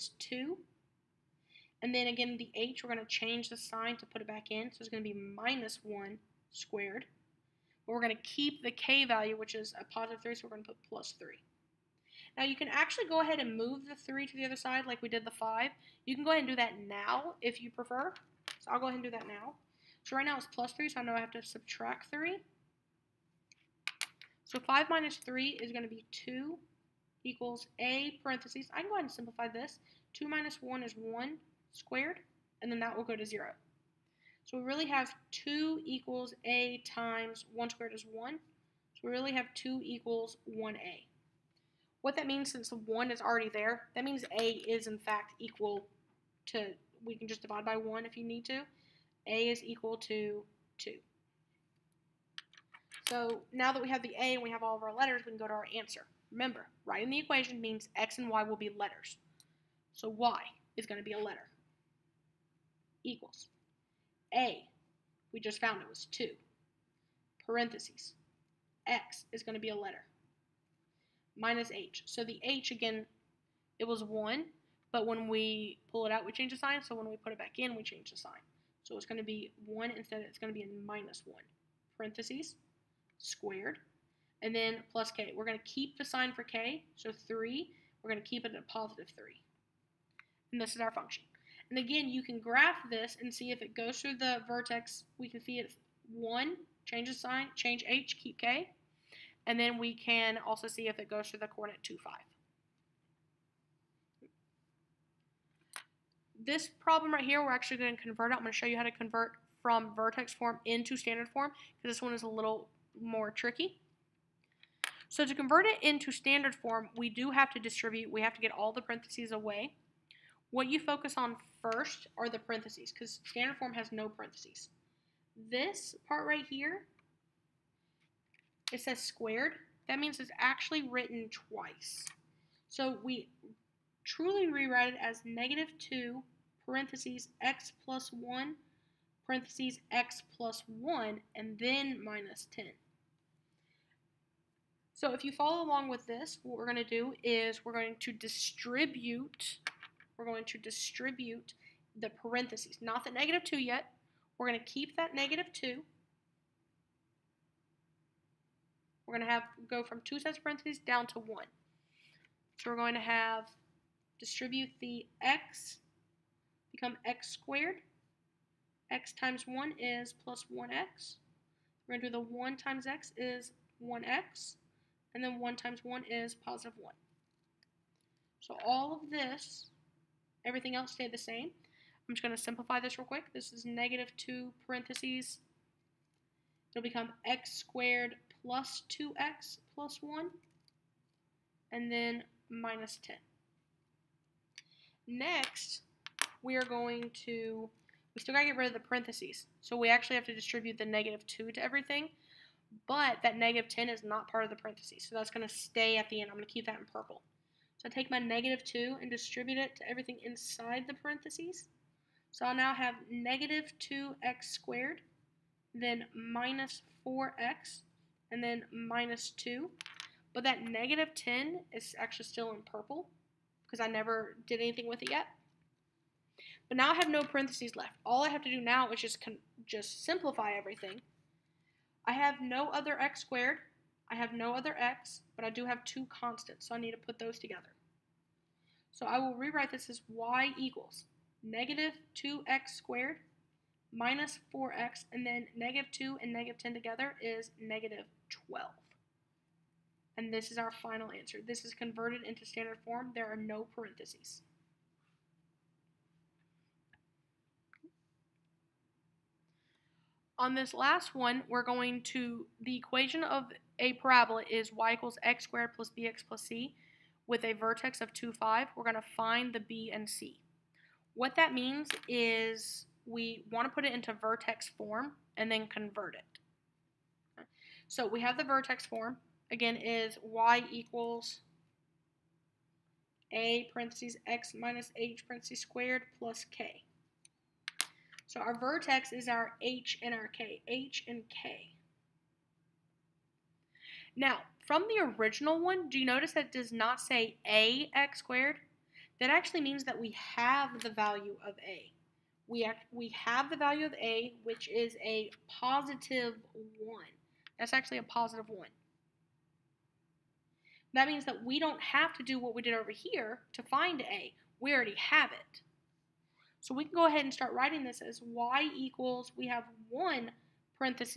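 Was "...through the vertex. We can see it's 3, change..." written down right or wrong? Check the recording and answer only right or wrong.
wrong.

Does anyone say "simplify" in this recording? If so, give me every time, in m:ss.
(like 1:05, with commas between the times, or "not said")
0:29, 3:02, 3:50.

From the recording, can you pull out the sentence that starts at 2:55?
And then 1 times 1 is positive 1.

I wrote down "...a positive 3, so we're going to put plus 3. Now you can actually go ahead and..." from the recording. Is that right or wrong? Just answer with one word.
right.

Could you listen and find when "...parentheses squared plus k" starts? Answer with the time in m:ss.
4:45.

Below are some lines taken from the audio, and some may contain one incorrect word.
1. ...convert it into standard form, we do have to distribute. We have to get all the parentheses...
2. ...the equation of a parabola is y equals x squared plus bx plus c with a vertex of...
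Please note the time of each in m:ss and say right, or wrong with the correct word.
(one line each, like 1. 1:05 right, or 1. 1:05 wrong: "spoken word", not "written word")
1. 1:55 right
2. 4:22 right.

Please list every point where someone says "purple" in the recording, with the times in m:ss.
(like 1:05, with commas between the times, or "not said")
3:26, 3:42.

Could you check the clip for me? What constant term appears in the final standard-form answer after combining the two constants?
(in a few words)
-12.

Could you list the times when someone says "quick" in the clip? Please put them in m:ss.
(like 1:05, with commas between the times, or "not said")
3:03.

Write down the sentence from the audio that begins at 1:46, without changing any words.
This problem right here, we're actually going to convert it.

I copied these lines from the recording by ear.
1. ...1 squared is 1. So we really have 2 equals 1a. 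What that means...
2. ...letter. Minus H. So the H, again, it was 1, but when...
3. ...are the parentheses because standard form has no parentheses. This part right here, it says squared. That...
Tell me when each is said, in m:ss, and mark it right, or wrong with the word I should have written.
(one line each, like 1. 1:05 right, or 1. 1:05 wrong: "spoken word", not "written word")
1. 0:37 right
2. 1:09 right
3. 2:02 right.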